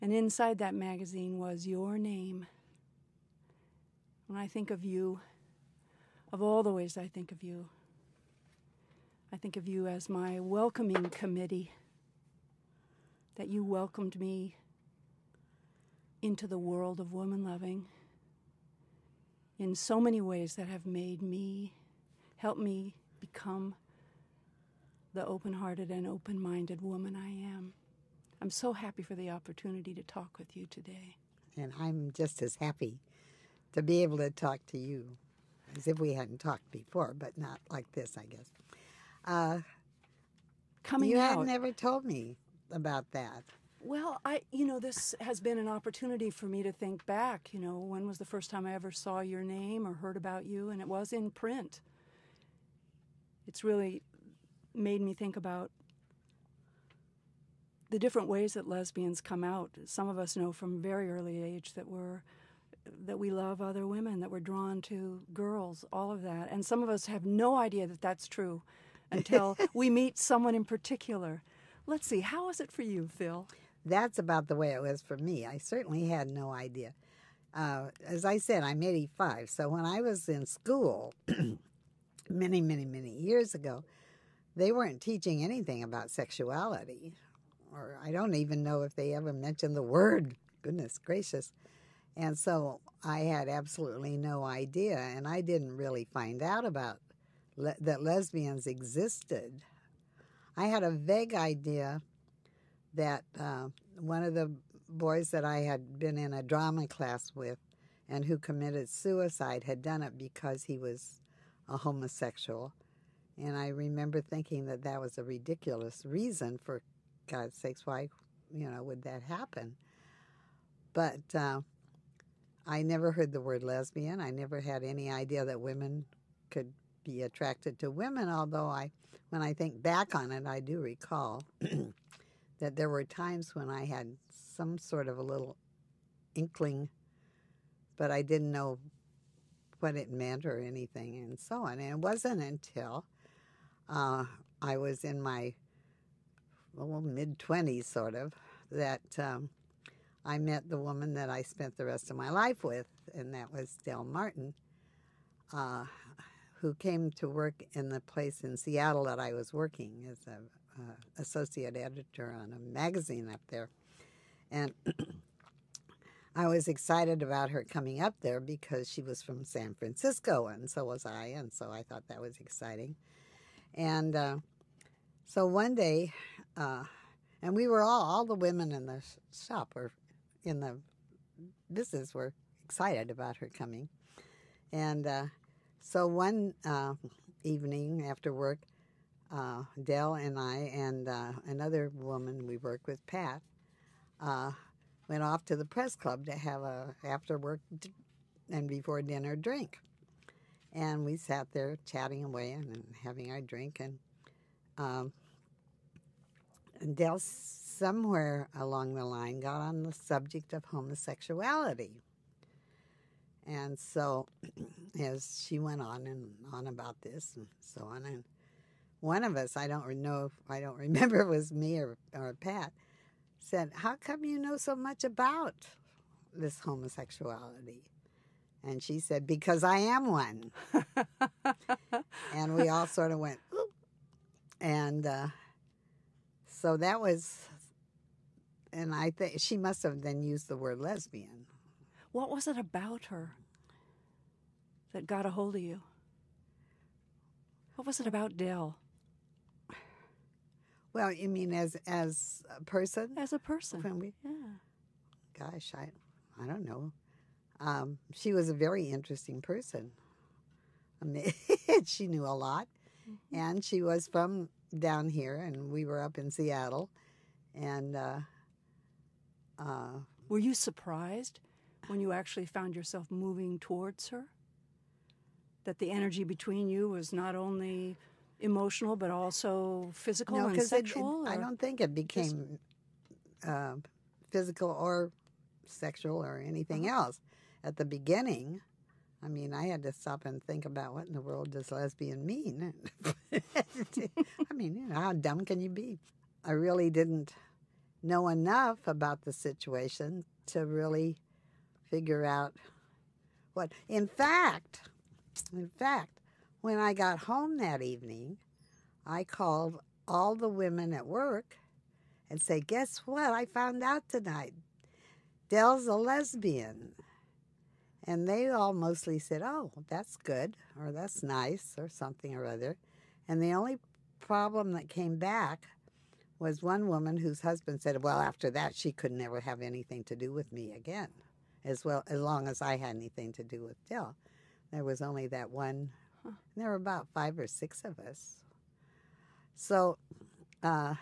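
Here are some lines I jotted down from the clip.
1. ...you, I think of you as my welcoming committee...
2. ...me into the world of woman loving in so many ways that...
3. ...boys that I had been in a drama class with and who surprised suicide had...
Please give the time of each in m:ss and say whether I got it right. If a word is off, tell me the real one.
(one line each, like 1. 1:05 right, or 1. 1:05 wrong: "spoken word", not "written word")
1. 0:07 right
2. 0:14 right
3. 1:44 wrong: "committed", not "surprised".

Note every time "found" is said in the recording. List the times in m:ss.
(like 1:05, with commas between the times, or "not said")
4:32, 5:13.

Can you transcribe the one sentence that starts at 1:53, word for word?
And I remember thinking that that was a ridiculous reason for God's sakes, why, you know, would that happen?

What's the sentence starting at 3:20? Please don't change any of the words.
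And we sat there chatting away and, and having our drink.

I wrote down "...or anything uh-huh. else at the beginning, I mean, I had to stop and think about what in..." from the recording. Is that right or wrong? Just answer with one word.
right.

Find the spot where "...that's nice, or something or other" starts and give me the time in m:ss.
5:20.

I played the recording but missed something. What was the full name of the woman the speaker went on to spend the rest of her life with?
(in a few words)
Del Martin.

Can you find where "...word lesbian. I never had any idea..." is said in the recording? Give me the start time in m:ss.
2:03.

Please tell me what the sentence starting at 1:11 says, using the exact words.
Let's see, how is it for you, Phil?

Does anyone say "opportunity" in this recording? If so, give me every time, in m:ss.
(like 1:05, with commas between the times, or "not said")
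0:29, 0:45.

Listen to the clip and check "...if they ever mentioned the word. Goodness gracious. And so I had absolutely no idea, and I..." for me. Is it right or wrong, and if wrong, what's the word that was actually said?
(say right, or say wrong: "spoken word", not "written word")
right.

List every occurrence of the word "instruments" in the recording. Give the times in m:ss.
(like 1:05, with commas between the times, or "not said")
not said.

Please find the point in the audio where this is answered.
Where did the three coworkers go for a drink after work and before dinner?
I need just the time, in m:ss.
3:15.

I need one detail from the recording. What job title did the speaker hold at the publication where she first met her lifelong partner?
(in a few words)
associate editor.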